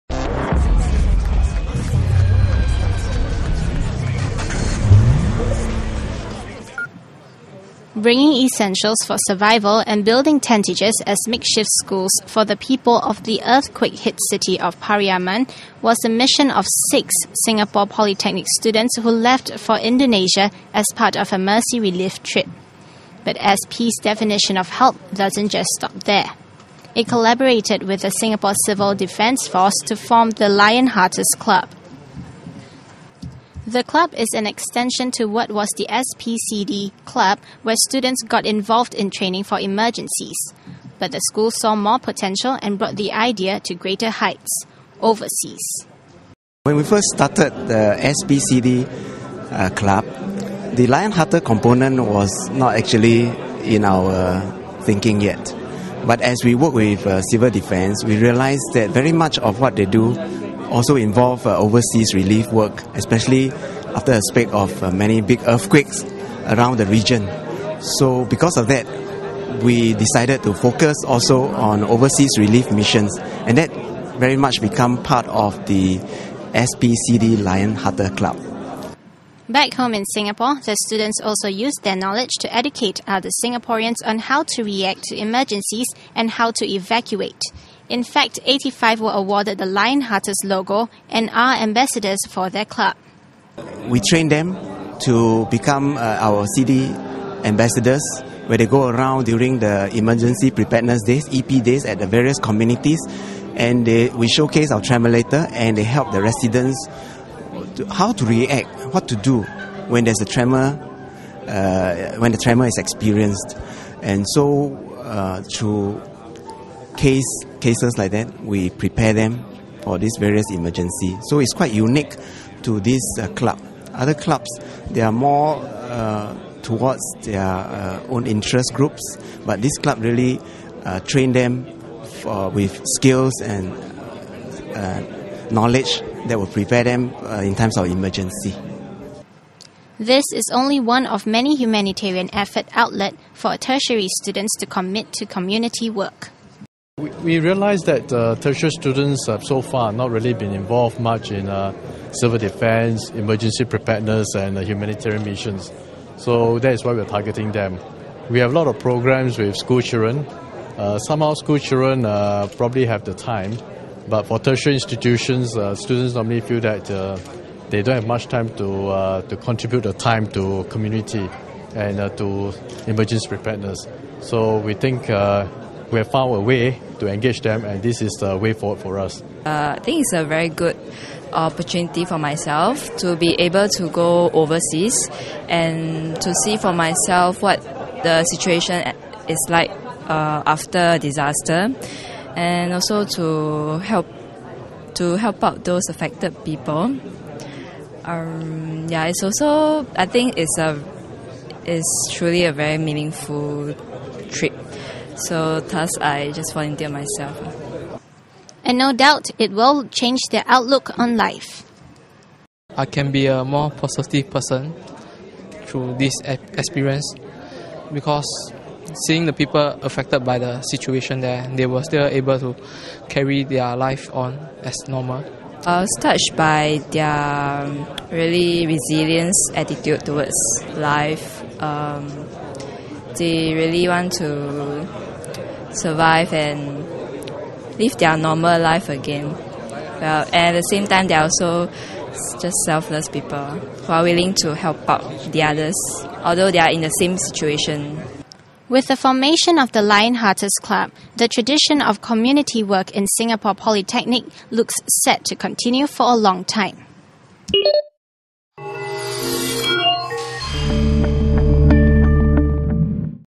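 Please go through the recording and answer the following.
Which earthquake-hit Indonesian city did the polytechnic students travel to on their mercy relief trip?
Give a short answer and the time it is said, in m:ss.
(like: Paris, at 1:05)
Pariaman, at 0:14.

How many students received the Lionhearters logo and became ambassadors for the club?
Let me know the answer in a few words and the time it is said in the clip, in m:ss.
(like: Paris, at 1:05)
85, at 1:28.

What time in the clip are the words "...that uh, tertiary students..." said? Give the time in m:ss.
2:27.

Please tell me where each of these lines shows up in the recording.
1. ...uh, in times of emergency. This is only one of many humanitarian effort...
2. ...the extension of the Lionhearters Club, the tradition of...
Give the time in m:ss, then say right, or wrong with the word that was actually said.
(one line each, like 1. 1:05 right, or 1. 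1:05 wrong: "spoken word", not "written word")
1. 2:17 right
2. 4:08 wrong: "formation", not "extension".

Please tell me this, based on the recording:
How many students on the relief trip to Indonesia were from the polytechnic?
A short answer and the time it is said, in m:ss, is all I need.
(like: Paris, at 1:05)
6, at 0:16.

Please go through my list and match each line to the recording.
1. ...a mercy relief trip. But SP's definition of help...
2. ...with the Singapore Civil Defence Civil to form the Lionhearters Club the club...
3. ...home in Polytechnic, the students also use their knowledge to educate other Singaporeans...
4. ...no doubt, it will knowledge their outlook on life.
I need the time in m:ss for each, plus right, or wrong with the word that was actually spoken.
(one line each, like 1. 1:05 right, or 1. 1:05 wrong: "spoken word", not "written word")
1. 0:21 right
2. 0:27 wrong: "Force", not "Civil"
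3. 1:19 wrong: "Singapore", not "Polytechnic"
4. 3:28 wrong: "change", not "knowledge".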